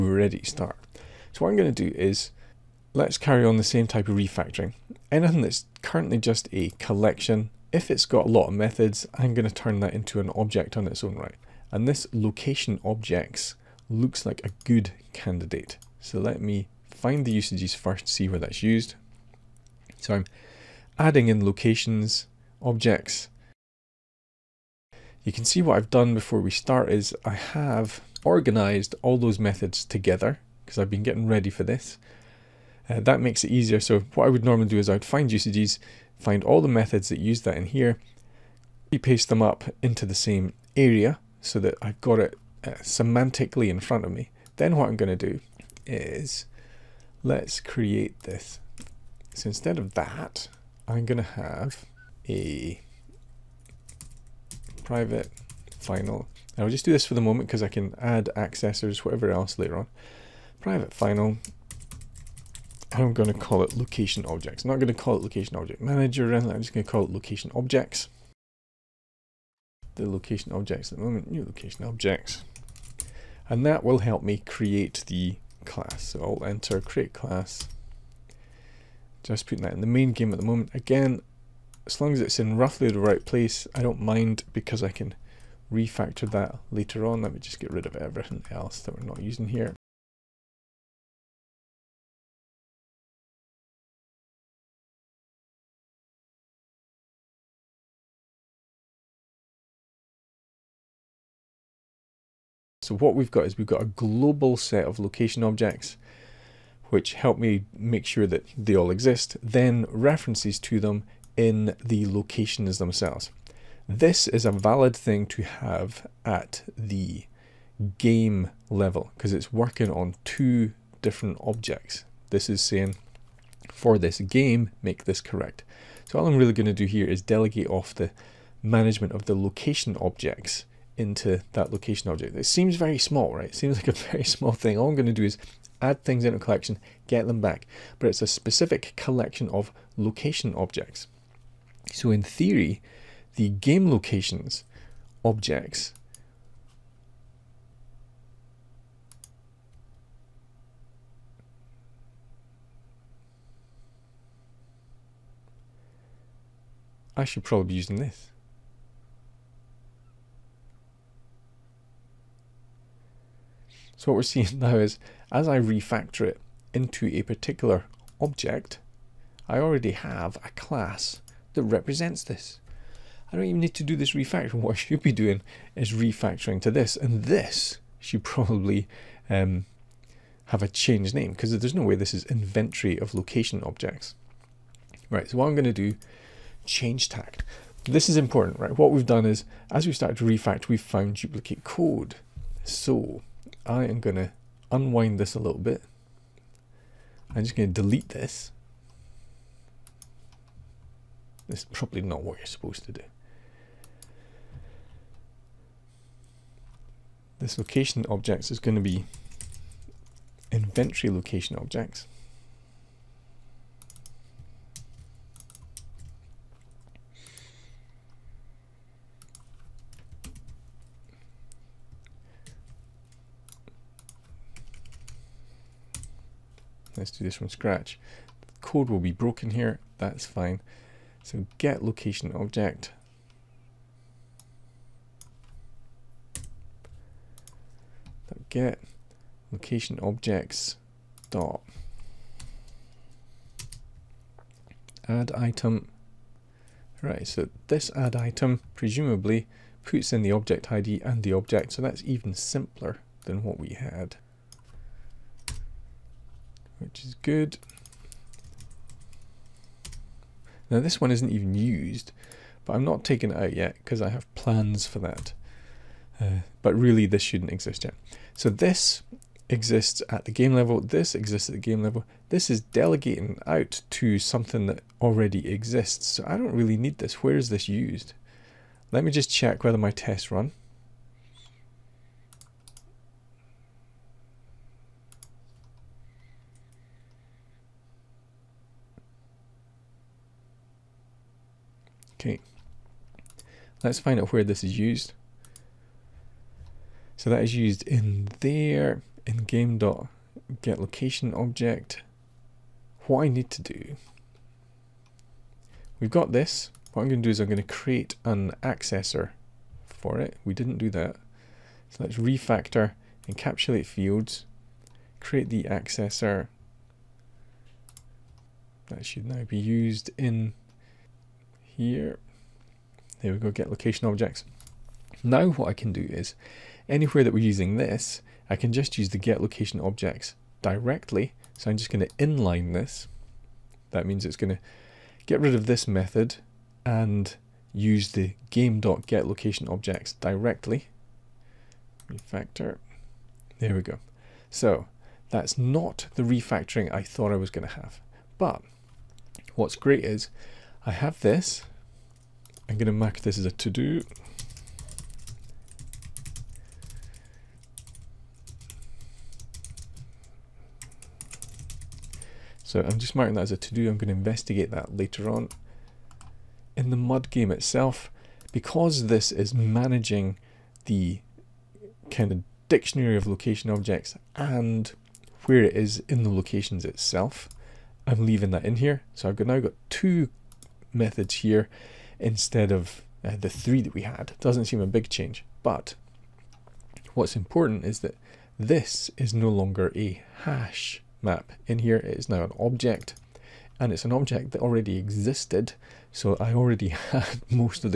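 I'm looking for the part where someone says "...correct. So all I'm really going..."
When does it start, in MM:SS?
02:05.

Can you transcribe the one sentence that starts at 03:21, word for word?
This is probably not what you're supposed to do.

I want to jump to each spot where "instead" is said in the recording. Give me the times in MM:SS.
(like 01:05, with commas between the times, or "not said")
00:49, 06:22.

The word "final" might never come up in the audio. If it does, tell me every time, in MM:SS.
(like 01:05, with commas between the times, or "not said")
00:55, 01:00.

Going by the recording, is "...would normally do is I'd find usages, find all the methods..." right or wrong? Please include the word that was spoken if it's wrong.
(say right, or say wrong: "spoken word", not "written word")
right.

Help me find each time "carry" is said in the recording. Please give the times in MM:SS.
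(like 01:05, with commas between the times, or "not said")
00:03.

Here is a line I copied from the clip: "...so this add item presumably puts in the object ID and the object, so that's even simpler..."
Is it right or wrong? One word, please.
right.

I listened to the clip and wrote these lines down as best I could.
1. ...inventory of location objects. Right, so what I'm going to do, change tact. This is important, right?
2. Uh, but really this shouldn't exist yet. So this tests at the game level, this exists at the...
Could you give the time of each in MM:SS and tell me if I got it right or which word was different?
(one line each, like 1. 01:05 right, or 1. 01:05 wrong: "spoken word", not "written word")
1. 03:02 right
2. 04:26 wrong: "exists", not "tests".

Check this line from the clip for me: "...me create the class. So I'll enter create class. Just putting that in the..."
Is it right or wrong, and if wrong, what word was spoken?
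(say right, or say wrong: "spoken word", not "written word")
right.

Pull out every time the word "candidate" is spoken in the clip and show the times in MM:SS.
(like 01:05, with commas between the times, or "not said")
00:15.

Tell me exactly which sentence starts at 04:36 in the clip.
So I don't really need this.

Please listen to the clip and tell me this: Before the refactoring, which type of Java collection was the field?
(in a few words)
hash map.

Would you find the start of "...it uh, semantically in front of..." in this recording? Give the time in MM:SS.
00:42.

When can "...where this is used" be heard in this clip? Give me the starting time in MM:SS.
04:54.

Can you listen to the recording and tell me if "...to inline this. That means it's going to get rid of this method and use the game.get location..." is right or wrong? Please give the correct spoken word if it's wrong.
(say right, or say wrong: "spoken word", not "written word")
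right.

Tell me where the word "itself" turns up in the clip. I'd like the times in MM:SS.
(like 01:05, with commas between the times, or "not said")
06:07, 06:16.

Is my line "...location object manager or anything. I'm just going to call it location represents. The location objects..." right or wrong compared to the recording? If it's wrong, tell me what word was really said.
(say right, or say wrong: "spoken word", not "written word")
wrong: "objects", not "represents".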